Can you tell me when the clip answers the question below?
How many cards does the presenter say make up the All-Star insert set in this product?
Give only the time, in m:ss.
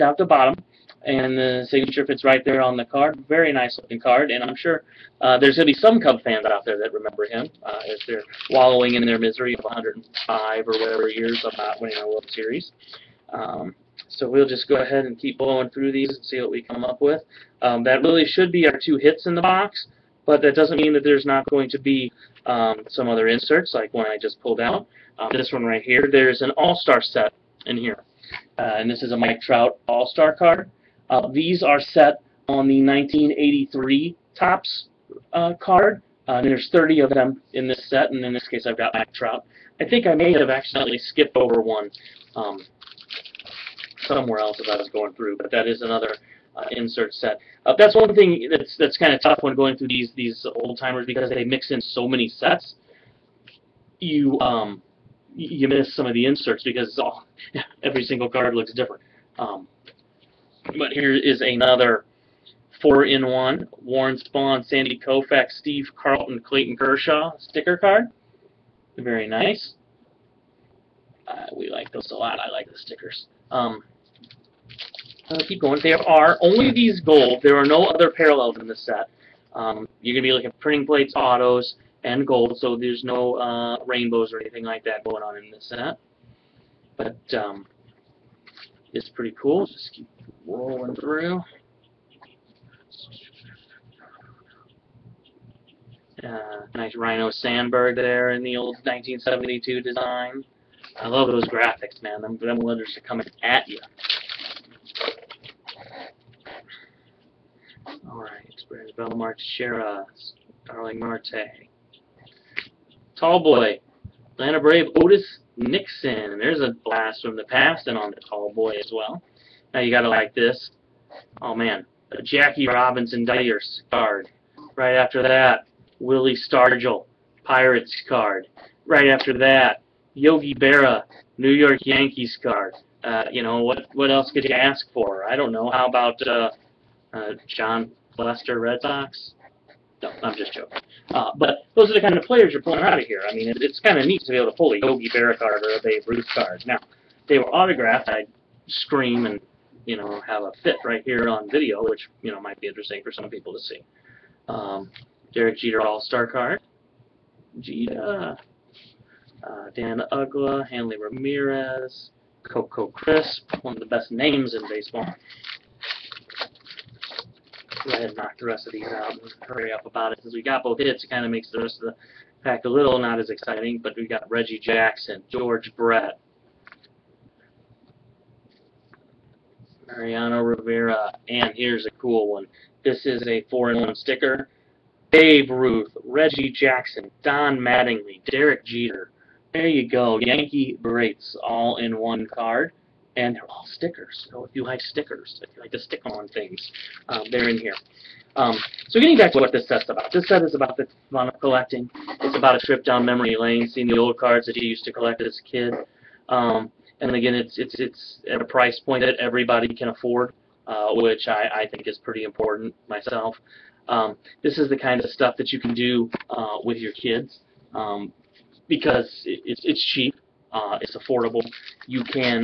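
0:36.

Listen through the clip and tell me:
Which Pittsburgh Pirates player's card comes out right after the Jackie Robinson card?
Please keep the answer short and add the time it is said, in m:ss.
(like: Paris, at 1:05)
Willie Stargell, at 2:05.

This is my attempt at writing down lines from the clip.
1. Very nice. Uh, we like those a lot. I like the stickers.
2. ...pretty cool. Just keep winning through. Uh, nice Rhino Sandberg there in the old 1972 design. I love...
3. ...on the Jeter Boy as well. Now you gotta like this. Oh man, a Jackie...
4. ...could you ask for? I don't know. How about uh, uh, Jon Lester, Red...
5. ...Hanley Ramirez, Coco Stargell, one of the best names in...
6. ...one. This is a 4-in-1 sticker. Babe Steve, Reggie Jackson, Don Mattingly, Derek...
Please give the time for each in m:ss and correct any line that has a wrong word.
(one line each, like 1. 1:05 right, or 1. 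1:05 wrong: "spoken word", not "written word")
1. 1:08 right
2. 1:29 wrong: "rolling", not "winning"
3. 1:57 wrong: "Tall", not "Jeter"
4. 2:14 right
5. 2:40 wrong: "Crisp", not "Stargell"
6. 3:02 wrong: "Ruth", not "Steve".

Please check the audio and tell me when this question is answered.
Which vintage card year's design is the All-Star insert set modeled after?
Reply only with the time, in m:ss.
0:32.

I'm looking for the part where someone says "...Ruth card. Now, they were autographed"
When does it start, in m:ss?
2:26.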